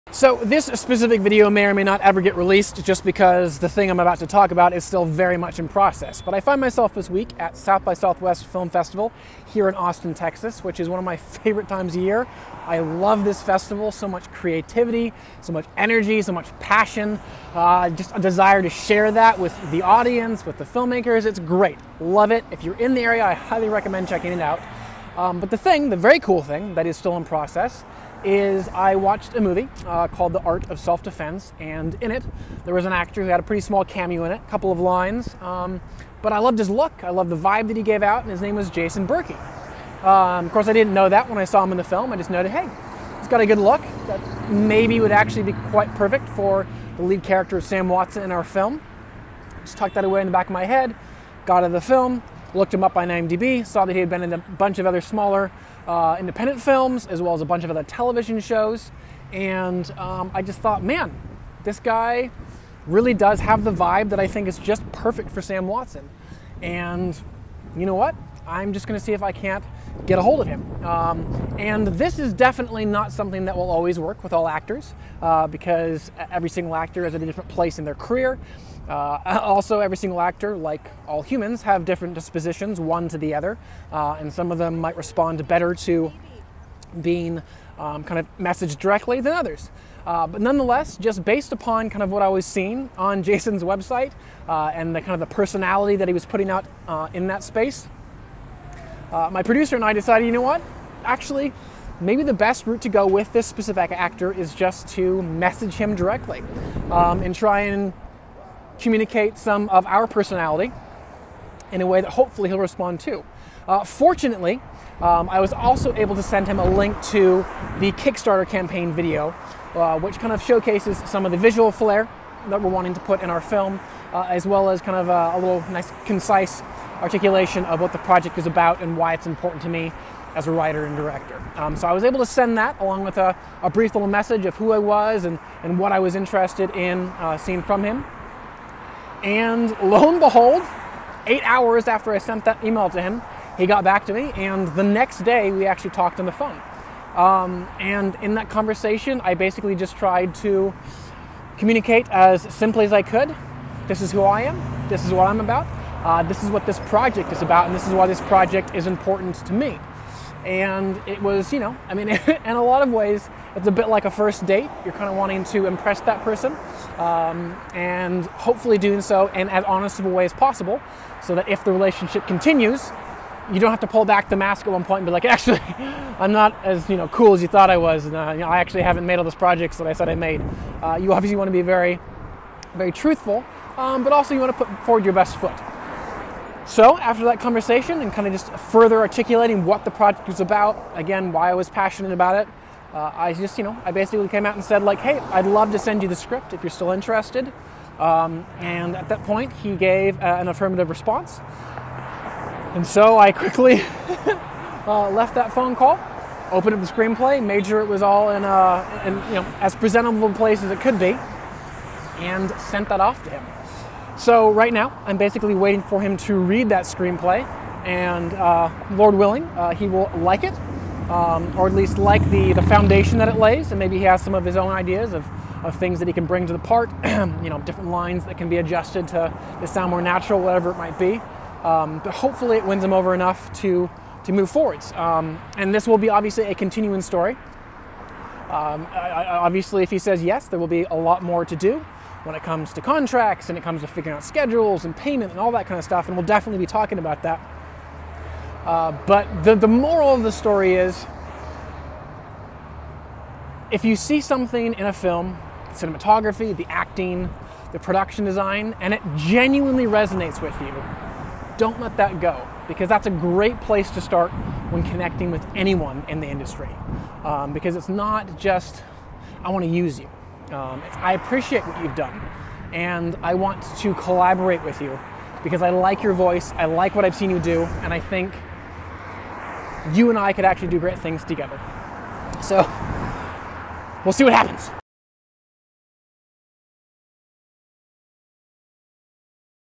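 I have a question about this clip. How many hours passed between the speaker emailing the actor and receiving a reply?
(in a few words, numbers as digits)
8.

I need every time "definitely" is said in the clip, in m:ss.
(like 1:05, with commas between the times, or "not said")
1:12, 4:06.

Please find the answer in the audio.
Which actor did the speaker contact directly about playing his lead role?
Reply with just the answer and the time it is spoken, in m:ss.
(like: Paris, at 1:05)
Jason Berkey, at 0:38.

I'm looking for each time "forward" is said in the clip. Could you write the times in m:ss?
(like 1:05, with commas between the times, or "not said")
3:04, 3:54.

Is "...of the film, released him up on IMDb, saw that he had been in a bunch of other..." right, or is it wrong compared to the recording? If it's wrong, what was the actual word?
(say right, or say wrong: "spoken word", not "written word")
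wrong: "looked", not "released".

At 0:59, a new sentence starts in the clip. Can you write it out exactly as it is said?
And um, I just thought, man, this guy really does have the vibe that I think is just perfect for Sam Watson.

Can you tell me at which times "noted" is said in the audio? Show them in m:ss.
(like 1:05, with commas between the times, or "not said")
0:42.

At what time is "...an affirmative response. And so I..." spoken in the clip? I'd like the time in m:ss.
3:20.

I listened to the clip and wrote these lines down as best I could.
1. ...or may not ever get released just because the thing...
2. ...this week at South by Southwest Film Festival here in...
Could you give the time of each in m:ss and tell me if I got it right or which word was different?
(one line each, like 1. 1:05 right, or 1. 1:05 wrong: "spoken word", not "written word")
1. 0:01 right
2. 0:06 right.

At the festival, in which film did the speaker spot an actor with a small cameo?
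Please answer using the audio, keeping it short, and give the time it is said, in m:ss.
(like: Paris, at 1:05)
The Art of Self Defense, at 0:30.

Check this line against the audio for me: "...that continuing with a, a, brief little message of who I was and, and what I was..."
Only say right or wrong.
wrong.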